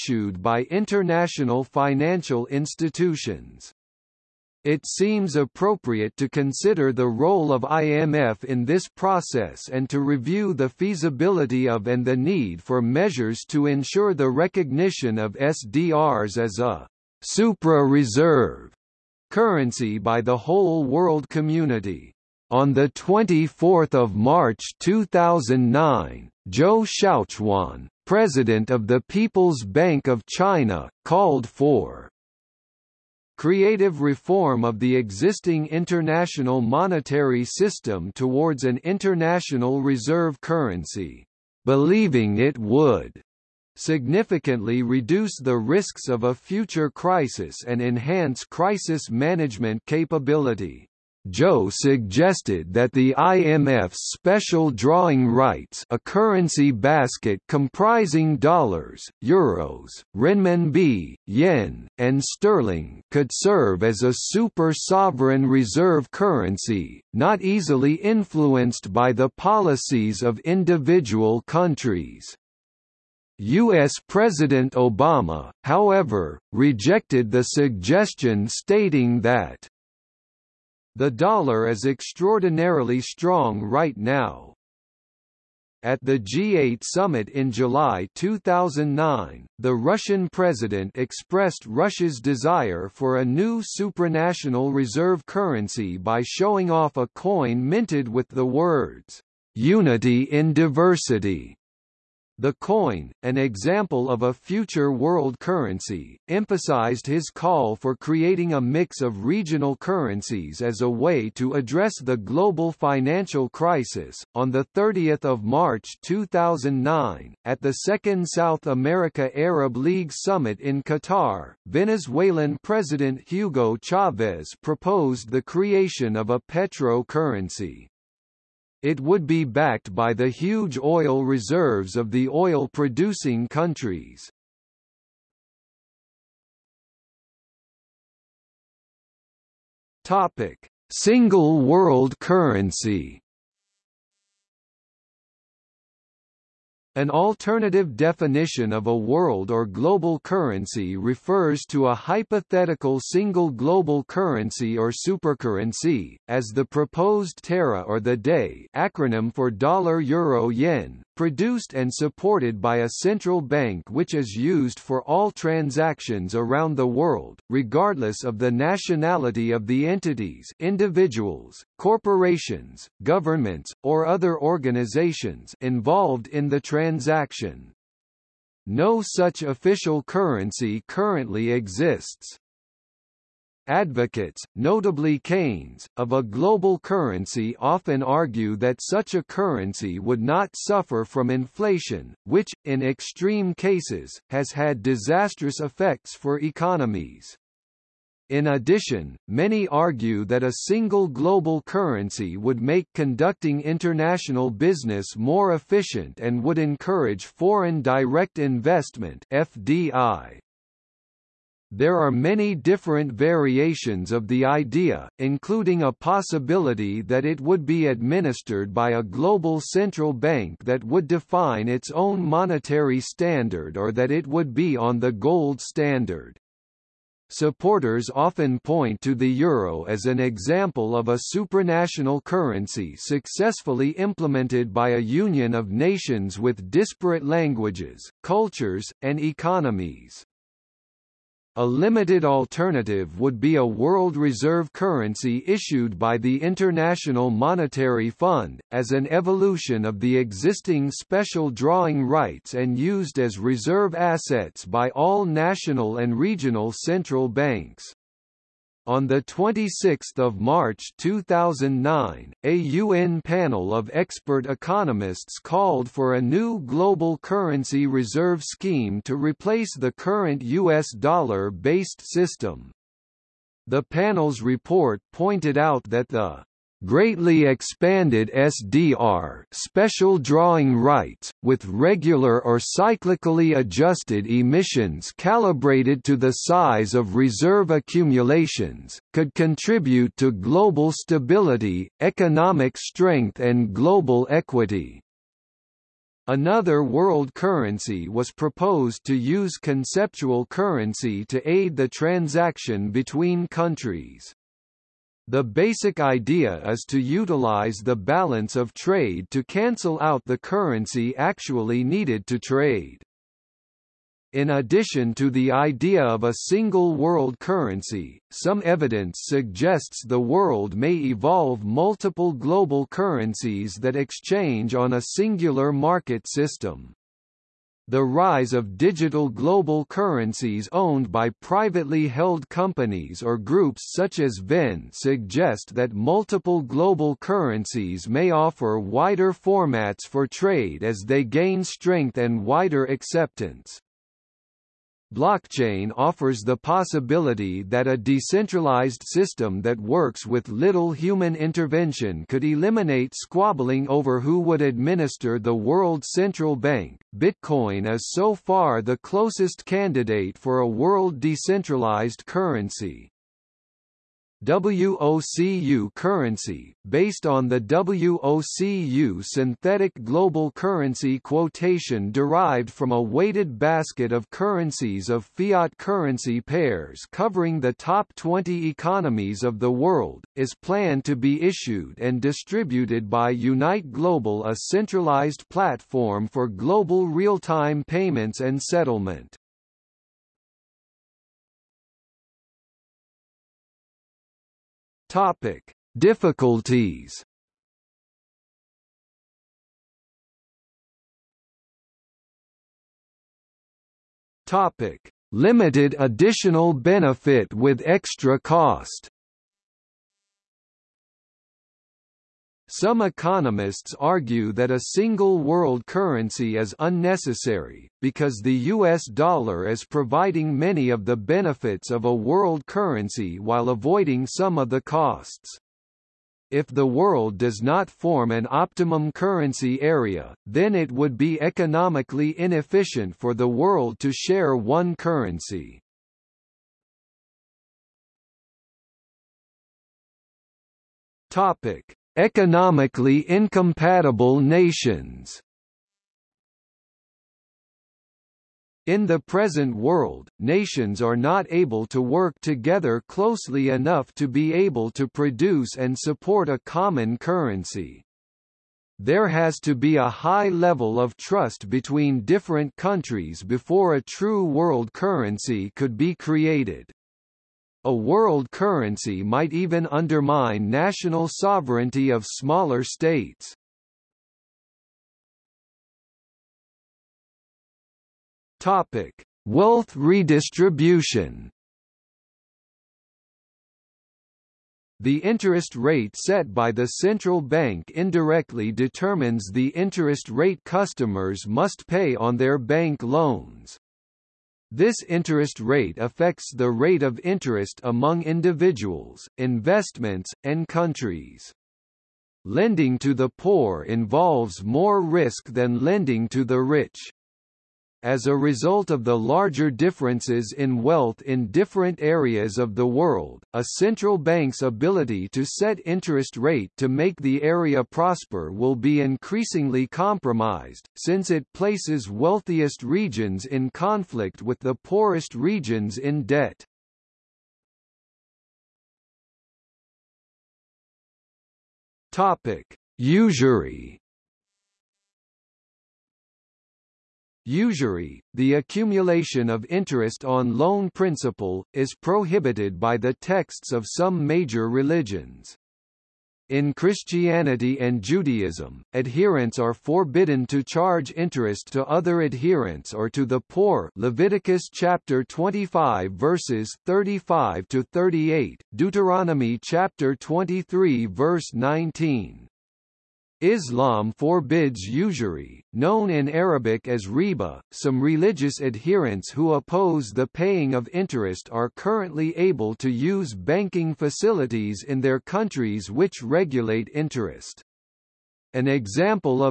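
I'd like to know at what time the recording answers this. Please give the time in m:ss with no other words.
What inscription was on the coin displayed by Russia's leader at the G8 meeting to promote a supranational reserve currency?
1:39.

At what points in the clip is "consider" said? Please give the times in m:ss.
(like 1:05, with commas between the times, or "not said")
0:06.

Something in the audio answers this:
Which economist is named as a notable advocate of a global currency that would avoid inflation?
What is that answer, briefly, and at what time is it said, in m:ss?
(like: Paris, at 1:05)
Keynes, at 3:05.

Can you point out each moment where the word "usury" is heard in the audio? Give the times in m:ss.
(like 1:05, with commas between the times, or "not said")
8:52, 8:57, 9:24.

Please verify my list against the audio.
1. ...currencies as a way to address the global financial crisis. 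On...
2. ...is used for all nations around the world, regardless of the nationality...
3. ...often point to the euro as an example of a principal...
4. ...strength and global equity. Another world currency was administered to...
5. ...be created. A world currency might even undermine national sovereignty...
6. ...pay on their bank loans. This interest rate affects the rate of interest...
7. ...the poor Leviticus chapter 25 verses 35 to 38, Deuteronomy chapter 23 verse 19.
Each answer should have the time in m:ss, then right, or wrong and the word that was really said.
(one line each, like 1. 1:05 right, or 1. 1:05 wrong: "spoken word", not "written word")
1. 1:49 right
2. 2:44 wrong: "transactions", not "nations"
3. 3:48 wrong: "supranational", not "principal"
4. 4:52 wrong: "proposed", not "administered"
5. 7:45 right
6. 8:11 right
7. 9:13 right.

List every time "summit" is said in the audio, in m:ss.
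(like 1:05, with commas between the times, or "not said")
1:26, 2:00.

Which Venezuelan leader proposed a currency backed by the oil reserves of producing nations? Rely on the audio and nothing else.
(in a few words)
Hugo Chavez.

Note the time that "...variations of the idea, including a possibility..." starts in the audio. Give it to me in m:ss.
3:33.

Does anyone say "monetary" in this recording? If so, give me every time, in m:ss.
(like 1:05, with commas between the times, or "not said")
0:36, 3:42, 4:07.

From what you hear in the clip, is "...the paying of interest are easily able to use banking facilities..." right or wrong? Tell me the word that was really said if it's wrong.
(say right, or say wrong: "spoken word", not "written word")
wrong: "currently", not "easily".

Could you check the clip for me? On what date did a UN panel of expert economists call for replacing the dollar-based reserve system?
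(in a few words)
26 March 2009.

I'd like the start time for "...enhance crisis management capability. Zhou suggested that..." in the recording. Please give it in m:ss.
0:47.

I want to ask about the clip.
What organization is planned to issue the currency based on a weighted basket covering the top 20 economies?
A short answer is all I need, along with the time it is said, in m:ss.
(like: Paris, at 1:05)
Unite Global, at 6:23.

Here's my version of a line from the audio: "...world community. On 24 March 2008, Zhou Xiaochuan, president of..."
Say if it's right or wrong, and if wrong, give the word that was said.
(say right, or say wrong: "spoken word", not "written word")
wrong: "2009", not "2008".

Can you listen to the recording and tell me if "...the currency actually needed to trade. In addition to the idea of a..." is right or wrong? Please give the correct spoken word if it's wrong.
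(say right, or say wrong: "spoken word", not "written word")
right.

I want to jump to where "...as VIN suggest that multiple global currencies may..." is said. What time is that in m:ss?
5:34.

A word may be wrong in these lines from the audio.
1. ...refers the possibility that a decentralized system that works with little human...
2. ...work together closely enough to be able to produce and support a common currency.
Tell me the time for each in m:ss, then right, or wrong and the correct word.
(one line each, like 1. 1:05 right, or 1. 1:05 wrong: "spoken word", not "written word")
1. 5:45 wrong: "offers", not "refers"
2. 7:31 right.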